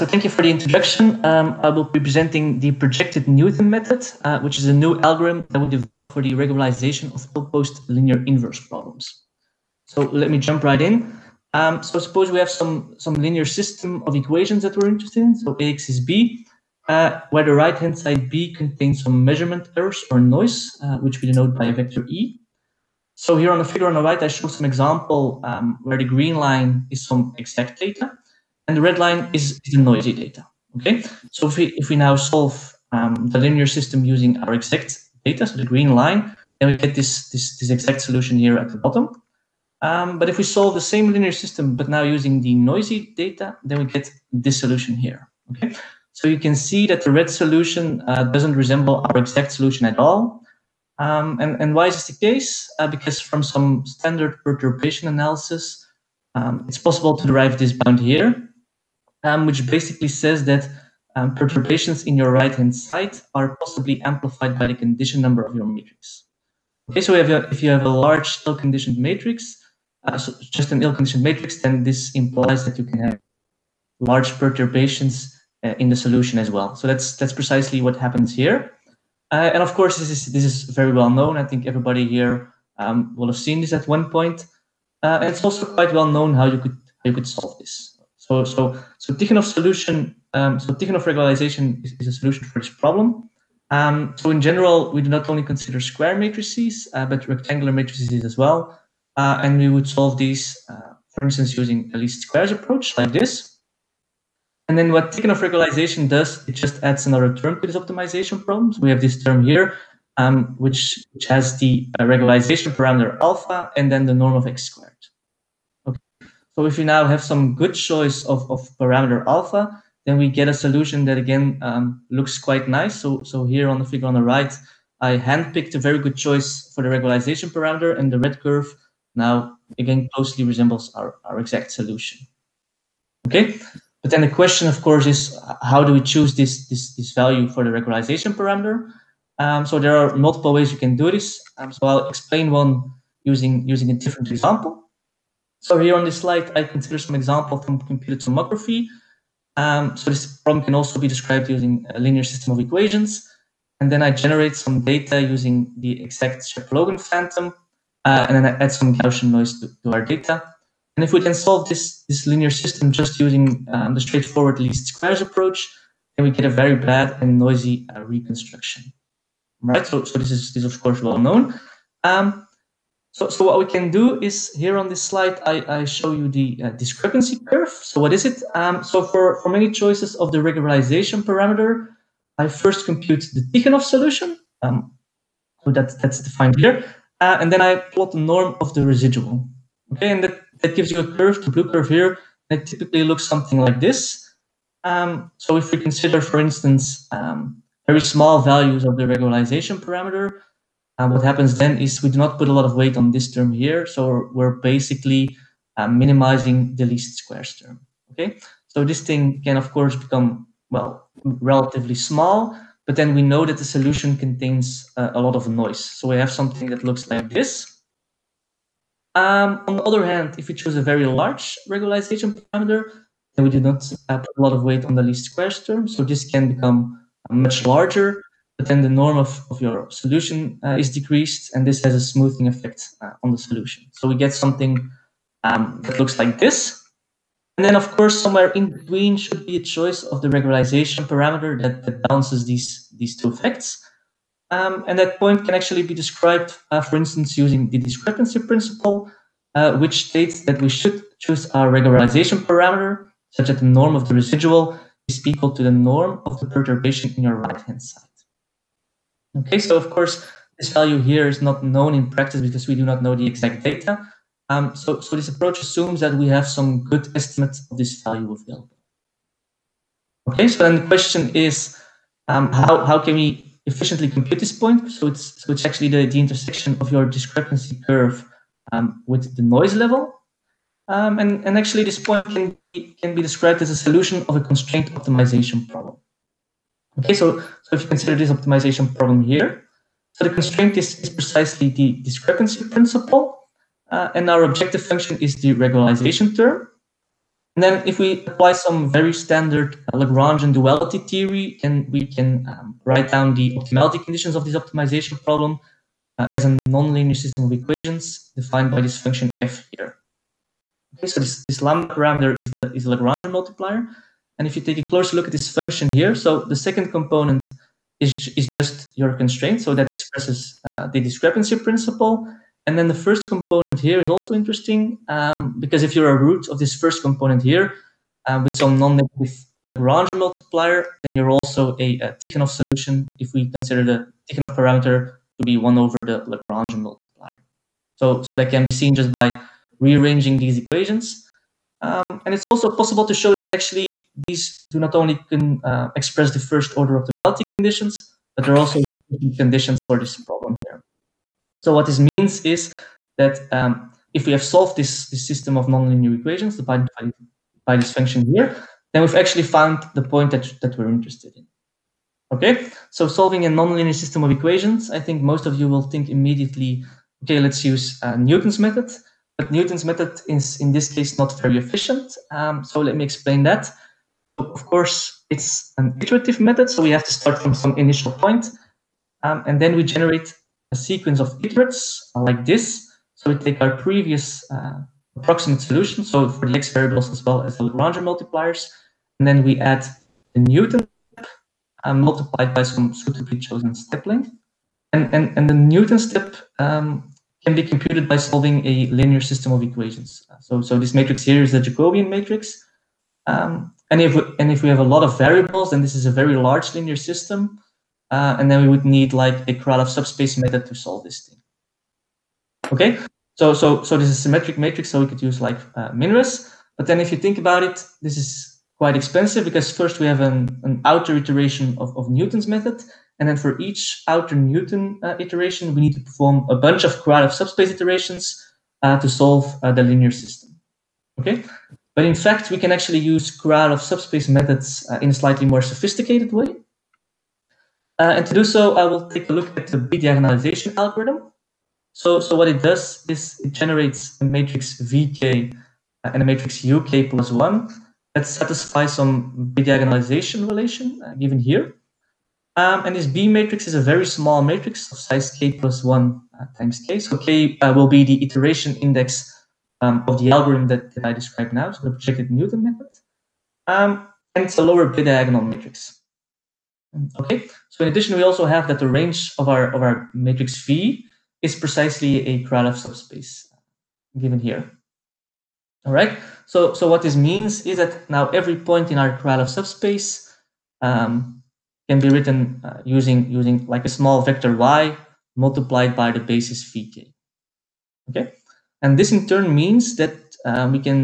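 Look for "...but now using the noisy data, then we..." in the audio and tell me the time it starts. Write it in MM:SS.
00:41.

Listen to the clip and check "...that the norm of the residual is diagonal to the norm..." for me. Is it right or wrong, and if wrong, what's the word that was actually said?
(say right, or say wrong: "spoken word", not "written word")
wrong: "equal", not "diagonal".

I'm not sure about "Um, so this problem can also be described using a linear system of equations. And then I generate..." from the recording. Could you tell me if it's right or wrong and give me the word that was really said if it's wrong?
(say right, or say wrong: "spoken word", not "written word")
right.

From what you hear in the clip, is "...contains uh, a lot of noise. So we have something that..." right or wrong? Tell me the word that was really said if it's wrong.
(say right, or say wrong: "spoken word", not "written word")
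right.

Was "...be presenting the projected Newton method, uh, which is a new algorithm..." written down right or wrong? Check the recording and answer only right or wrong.
right.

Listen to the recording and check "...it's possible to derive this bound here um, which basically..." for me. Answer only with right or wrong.
right.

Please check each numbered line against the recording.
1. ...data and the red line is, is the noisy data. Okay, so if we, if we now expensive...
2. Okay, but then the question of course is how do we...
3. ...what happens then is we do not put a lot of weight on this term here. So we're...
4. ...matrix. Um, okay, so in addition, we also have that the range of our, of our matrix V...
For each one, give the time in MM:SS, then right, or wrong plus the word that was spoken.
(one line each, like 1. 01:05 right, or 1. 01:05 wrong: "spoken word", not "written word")
1. 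00:27 wrong: "solve", not "expensive"
2. 02:13 right
3. 03:21 right
4. 07:45 right.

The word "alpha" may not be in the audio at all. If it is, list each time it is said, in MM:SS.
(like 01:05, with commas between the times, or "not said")
01:53, 01:59.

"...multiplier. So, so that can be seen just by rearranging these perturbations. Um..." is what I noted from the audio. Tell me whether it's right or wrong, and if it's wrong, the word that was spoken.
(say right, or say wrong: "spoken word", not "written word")
wrong: "equations", not "perturbations".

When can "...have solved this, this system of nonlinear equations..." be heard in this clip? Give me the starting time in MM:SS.
05:54.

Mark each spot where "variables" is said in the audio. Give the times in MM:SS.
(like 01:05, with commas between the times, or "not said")
06:26, 06:45.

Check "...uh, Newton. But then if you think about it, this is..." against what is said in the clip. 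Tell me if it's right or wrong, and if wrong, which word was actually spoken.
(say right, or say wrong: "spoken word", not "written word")
wrong: "Minres", not "Newton".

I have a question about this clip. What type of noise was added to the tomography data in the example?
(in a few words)
Gaussian noise.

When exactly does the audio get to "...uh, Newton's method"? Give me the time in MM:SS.
06:08.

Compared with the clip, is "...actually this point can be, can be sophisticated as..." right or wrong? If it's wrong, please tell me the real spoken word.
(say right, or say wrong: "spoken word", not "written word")
wrong: "described", not "sophisticated".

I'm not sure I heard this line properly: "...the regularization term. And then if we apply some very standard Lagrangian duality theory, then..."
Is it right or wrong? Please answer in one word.
right.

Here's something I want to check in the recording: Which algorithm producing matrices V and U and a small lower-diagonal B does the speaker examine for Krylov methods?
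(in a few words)
bidiagonalization algorithm.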